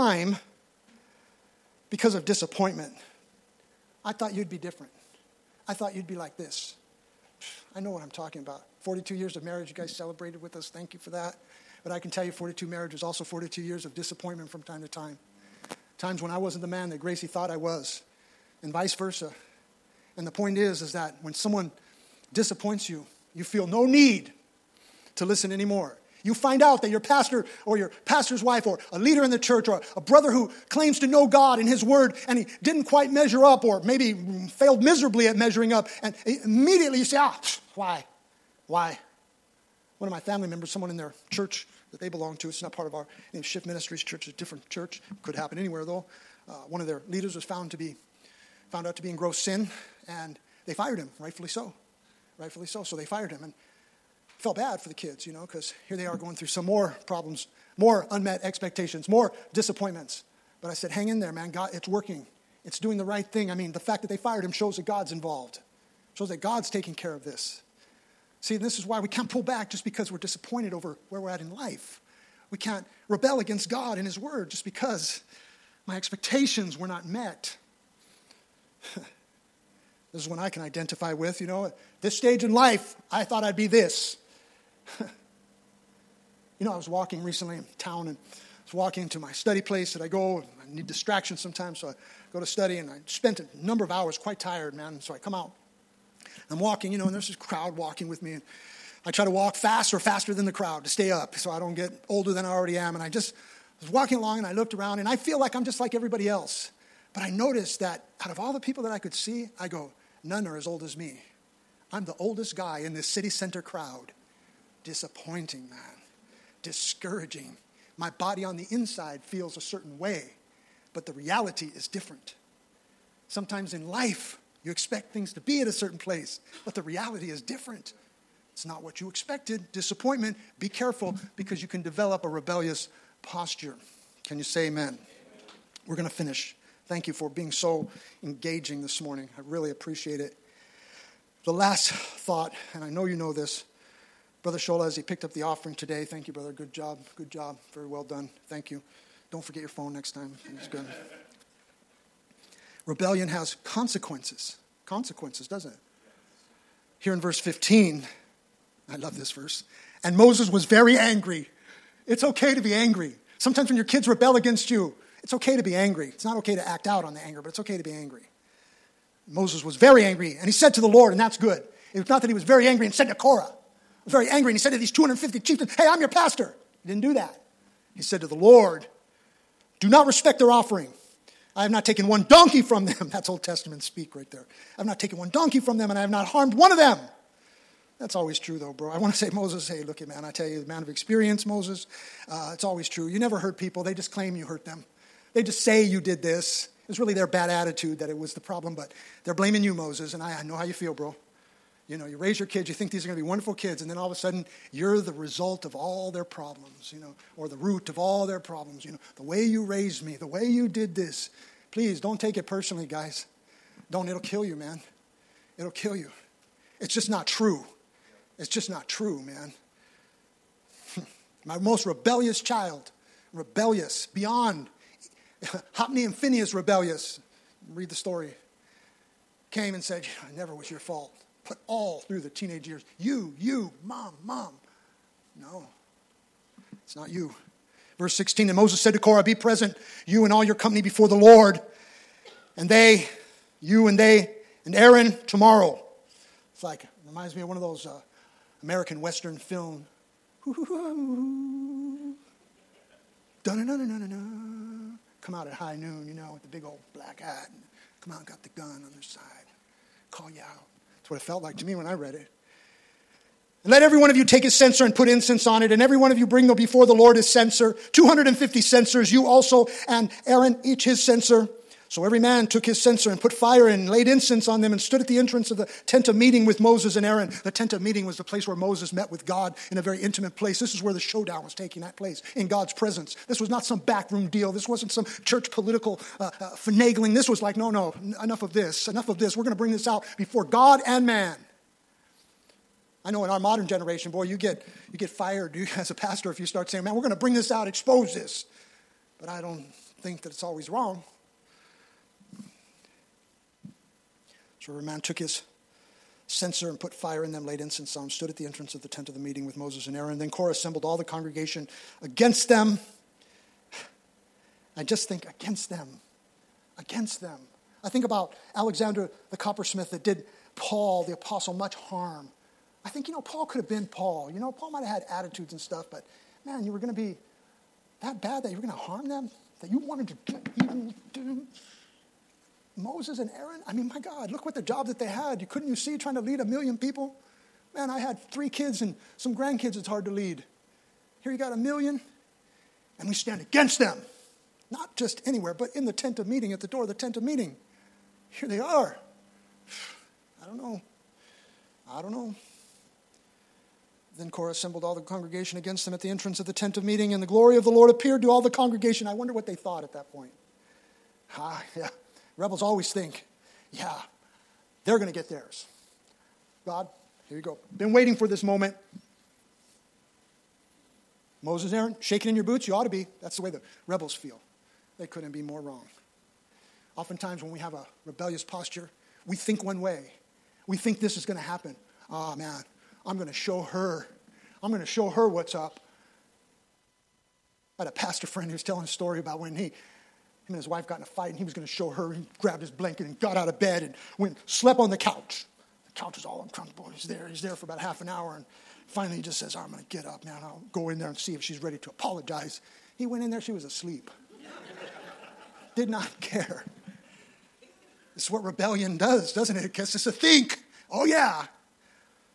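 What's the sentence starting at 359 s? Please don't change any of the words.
I wonder what they thought at that point.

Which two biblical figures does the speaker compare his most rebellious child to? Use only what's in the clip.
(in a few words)
Hophni and Phinehas.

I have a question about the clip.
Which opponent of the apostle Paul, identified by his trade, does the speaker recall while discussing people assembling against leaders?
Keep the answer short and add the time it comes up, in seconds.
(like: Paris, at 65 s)
Alexander the coppersmith, at 318 s.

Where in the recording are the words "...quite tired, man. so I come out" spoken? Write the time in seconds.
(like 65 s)
94 s.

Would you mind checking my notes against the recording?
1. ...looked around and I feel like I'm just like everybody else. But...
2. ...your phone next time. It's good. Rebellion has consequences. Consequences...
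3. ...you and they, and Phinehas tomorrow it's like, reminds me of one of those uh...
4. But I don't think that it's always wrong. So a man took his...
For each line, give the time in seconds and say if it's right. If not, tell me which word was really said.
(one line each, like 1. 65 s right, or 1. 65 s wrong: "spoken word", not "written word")
1. 104 s right
2. 149 s right
3. 243 s wrong: "Aaron", not "Phinehas"
4. 299 s right.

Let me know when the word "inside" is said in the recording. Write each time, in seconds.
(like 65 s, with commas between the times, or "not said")
118 s.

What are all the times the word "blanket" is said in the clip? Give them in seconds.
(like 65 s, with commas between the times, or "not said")
392 s.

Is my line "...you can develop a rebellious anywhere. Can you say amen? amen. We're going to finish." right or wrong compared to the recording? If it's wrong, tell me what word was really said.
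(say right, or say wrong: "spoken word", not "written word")
wrong: "posture", not "anywhere".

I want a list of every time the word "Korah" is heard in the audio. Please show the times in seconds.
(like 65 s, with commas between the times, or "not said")
173 s, 238 s, 310 s, 354 s.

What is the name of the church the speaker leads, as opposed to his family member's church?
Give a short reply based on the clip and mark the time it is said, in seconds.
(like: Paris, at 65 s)
Shift Ministries Church, at 43 s.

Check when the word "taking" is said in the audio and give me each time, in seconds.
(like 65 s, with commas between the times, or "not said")
66 s, 281 s.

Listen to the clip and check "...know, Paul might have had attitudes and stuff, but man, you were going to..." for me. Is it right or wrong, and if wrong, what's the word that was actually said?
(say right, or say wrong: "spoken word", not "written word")
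right.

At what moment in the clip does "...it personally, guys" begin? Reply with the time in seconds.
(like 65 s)
212 s.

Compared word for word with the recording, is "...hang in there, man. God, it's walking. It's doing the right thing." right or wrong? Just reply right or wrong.
wrong.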